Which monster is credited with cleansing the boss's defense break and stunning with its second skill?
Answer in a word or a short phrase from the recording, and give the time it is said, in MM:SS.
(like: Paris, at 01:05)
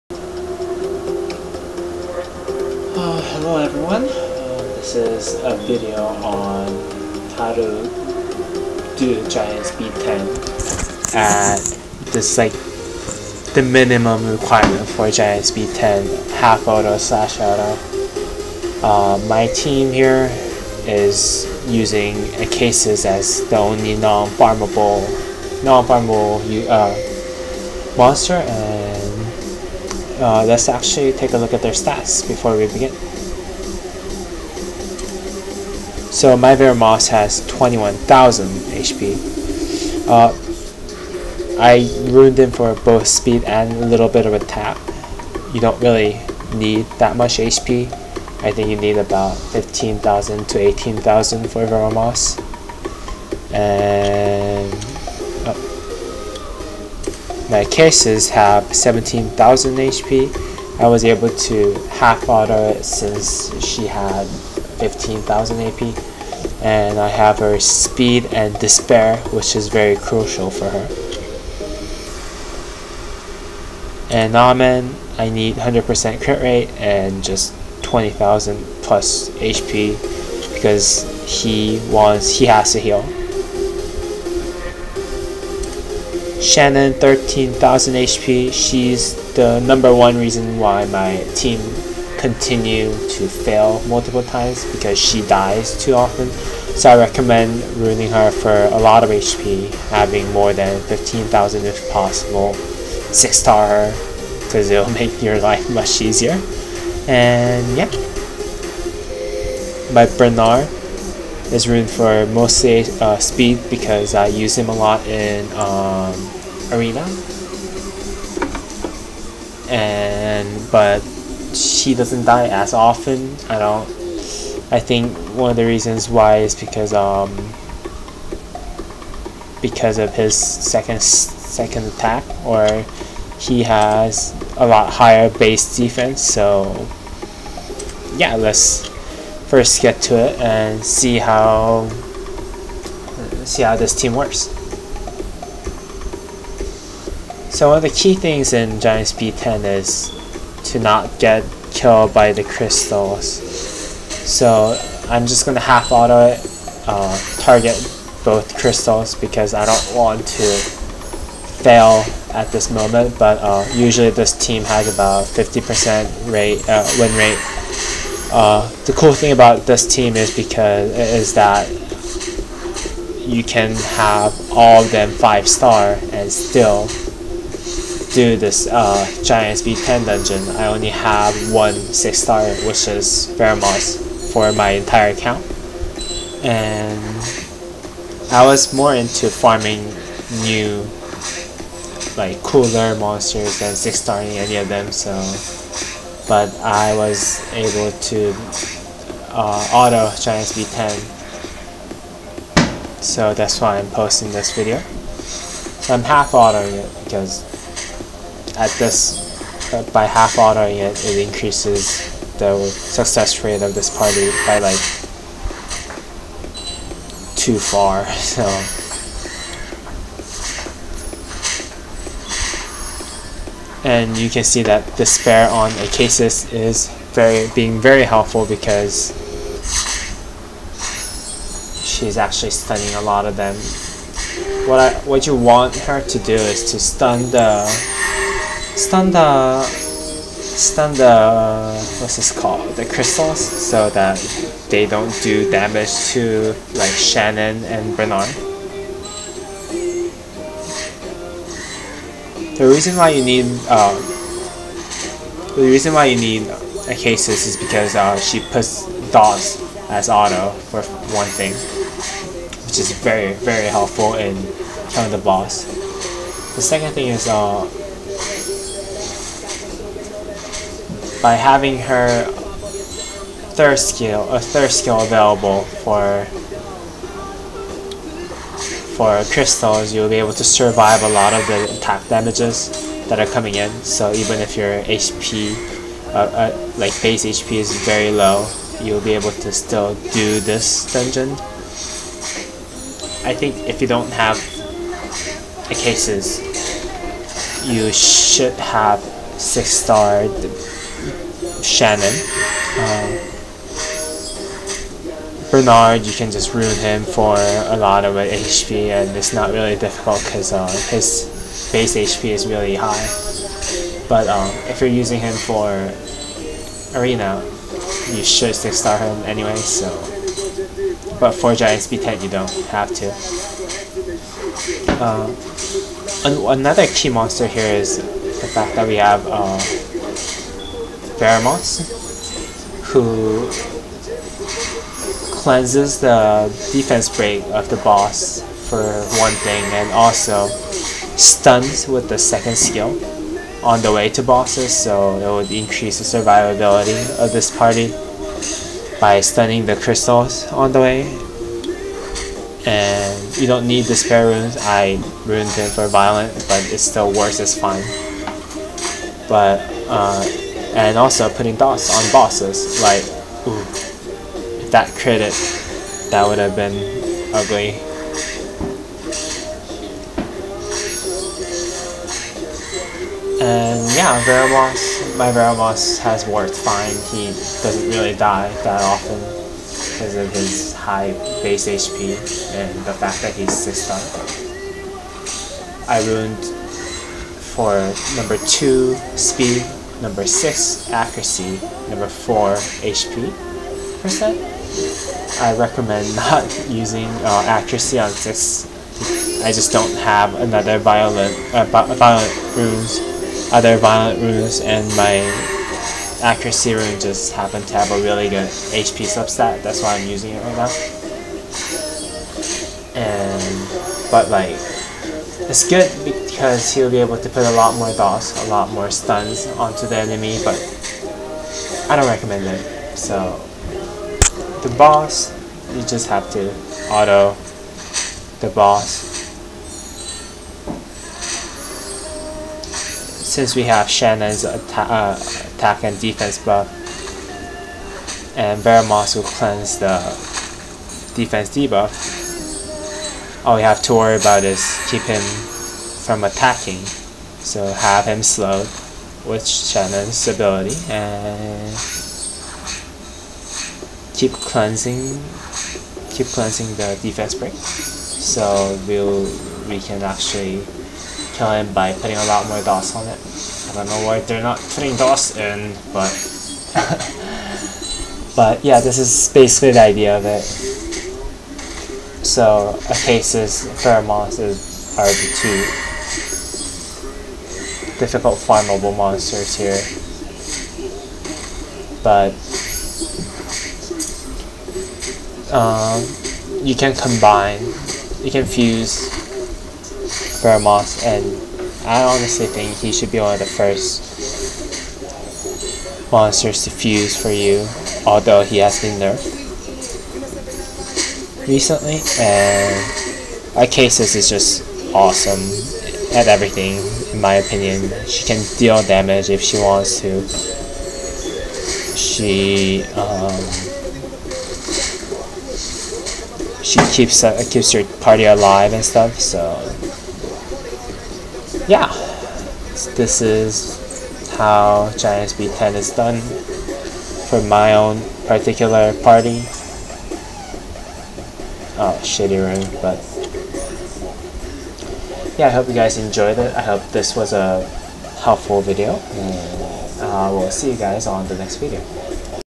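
Behemoth, at 05:31.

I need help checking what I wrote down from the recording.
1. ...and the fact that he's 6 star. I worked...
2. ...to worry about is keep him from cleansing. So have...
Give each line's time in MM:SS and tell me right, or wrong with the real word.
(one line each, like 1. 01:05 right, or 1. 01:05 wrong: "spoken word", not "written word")
1. 06:22 wrong: "ruined", not "worked"
2. 07:23 wrong: "attacking", not "cleansing".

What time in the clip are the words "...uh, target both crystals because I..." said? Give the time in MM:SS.
02:36.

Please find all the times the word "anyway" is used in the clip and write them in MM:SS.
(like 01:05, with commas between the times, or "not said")
05:19.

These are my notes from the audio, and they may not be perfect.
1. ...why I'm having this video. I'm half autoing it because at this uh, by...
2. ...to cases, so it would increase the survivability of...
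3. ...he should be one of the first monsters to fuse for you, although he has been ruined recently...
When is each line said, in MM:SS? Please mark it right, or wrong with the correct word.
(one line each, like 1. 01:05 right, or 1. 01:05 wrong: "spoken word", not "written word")
1. 03:23 wrong: "posting", not "having"
2. 05:44 wrong: "bosses", not "cases"
3. 08:12 wrong: "nerfed", not "ruined".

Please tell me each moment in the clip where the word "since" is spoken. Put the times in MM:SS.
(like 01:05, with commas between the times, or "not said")
01:02, 07:13.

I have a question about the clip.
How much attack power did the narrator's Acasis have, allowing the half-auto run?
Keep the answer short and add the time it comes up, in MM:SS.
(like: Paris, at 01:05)
15,000, at 01:04.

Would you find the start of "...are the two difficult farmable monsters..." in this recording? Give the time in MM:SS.
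07:54.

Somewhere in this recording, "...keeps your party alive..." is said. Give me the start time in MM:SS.
08:37.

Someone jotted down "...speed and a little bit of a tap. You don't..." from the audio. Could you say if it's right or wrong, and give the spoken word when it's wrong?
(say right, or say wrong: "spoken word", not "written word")
right.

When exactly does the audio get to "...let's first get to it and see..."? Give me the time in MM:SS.
02:18.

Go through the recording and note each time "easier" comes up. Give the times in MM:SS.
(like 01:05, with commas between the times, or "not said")
01:46.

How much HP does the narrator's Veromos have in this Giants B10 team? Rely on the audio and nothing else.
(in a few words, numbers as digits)
21,000.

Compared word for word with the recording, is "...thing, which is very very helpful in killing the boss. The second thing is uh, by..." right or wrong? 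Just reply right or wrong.
right.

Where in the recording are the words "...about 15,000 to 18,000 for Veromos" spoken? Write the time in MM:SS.
00:48.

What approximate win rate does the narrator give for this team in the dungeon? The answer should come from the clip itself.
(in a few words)
50%.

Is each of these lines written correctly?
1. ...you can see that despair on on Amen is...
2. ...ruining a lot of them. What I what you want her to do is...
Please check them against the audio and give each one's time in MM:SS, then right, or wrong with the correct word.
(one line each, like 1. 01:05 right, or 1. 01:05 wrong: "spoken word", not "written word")
1. 03:44 wrong: "Acasis", not "Amen"
2. 03:52 wrong: "stunning", not "ruining".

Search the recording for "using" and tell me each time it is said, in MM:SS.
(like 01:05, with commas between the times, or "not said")
00:21, 05:14, 06:36, 06:50.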